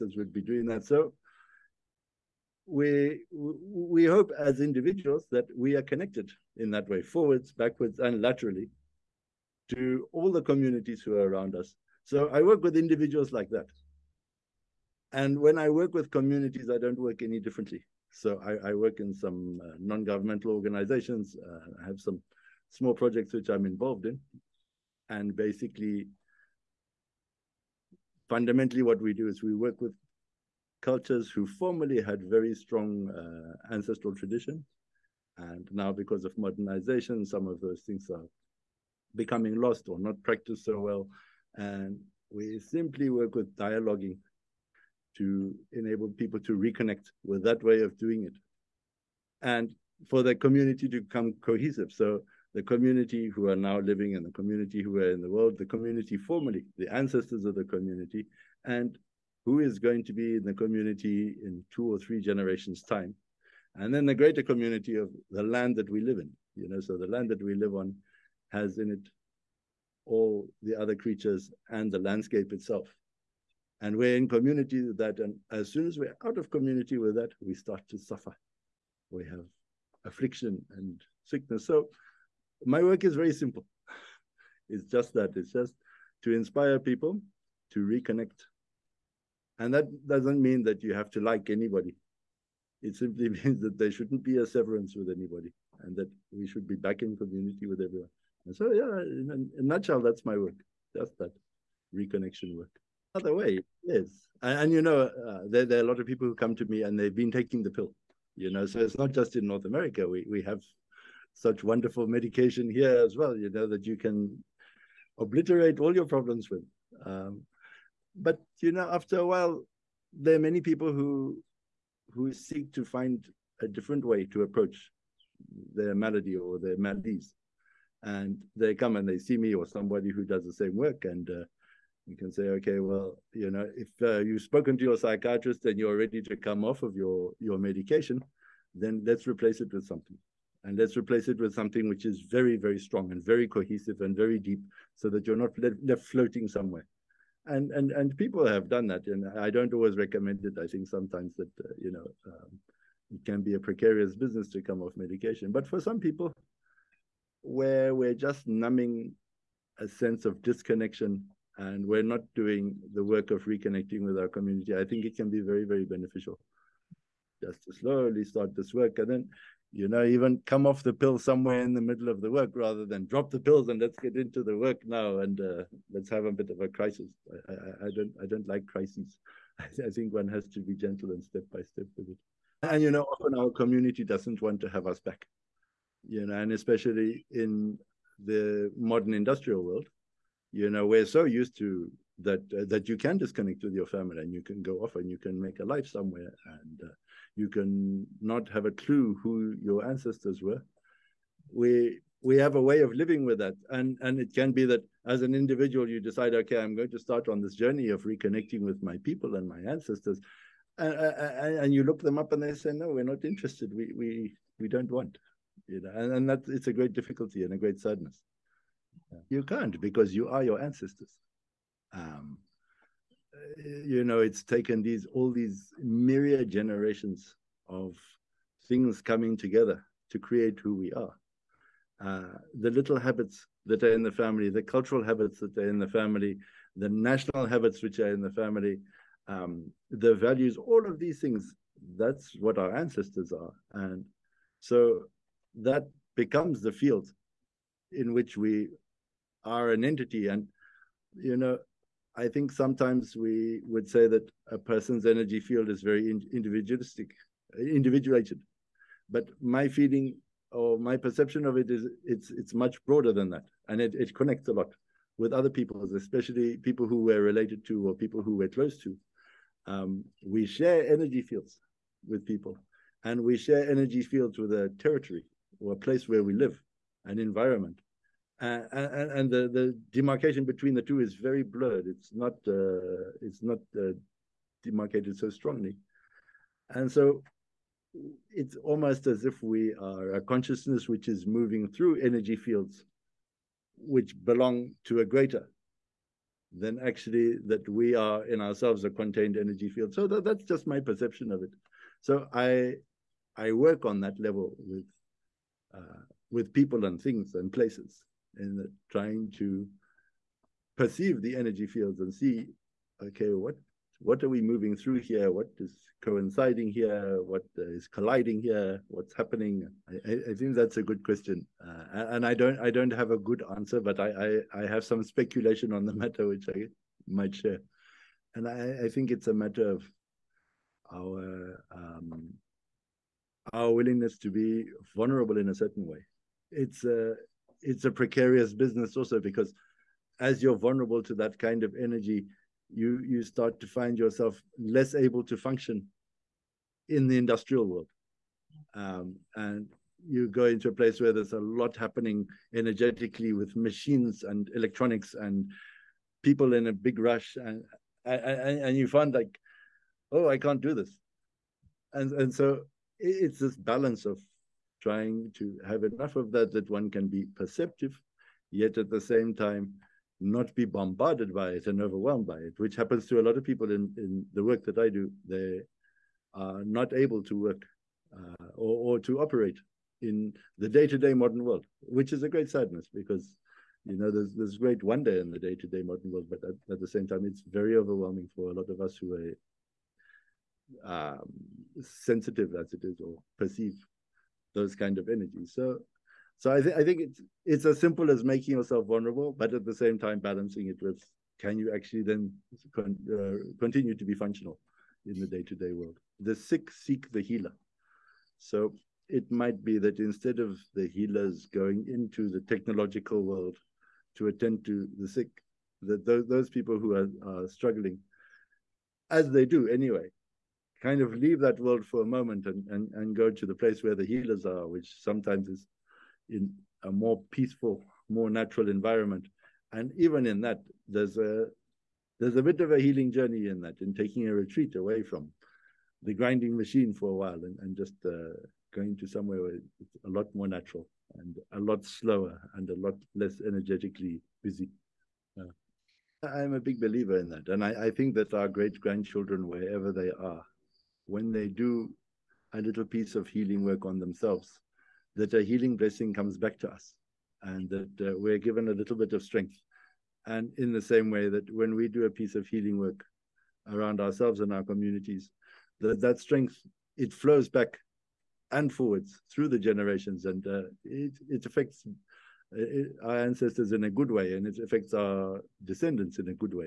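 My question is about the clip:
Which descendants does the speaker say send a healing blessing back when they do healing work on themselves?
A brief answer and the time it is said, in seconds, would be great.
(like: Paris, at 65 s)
great grandchildren, at 448 s.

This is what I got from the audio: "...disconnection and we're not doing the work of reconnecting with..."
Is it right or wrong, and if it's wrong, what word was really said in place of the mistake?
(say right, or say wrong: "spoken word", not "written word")
right.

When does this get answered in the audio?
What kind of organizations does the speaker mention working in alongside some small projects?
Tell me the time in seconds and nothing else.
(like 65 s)
19 s.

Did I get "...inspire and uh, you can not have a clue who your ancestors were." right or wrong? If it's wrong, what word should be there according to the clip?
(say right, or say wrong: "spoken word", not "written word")
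wrong: "somewhere", not "inspire".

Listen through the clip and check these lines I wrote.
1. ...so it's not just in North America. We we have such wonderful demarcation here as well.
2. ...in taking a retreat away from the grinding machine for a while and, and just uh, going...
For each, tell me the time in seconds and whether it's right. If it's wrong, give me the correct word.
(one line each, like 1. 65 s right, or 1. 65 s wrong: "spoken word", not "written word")
1. 108 s wrong: "medication", not "demarcation"
2. 433 s right.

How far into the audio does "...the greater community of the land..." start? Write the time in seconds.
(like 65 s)
64 s.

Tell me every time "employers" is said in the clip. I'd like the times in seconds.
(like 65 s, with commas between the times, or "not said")
not said.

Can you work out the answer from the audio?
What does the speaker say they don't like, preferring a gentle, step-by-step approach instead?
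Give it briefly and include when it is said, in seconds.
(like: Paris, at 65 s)
crises, at 178 s.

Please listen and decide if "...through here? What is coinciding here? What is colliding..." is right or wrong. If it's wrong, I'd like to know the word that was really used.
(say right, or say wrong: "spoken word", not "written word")
right.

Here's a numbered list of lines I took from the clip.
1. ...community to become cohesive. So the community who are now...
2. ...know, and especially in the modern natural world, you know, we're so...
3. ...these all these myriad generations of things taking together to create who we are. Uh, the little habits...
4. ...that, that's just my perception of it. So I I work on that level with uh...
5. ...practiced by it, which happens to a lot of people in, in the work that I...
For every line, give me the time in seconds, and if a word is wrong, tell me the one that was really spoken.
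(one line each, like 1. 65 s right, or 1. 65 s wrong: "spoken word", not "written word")
1. 50 s right
2. 186 s wrong: "industrial", not "natural"
3. 224 s wrong: "coming", not "taking"
4. 300 s right
5. 371 s wrong: "overwhelmed", not "practiced".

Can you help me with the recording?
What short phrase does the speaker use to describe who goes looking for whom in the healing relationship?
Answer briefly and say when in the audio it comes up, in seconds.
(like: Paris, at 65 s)
The sick seek the healer, at 406 s.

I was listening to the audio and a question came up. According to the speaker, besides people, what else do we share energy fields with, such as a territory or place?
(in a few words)
an environment.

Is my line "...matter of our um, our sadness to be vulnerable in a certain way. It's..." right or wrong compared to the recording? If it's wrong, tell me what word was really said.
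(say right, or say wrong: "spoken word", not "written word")
wrong: "willingness", not "sadness".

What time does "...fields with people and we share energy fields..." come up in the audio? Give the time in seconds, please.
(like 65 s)
271 s.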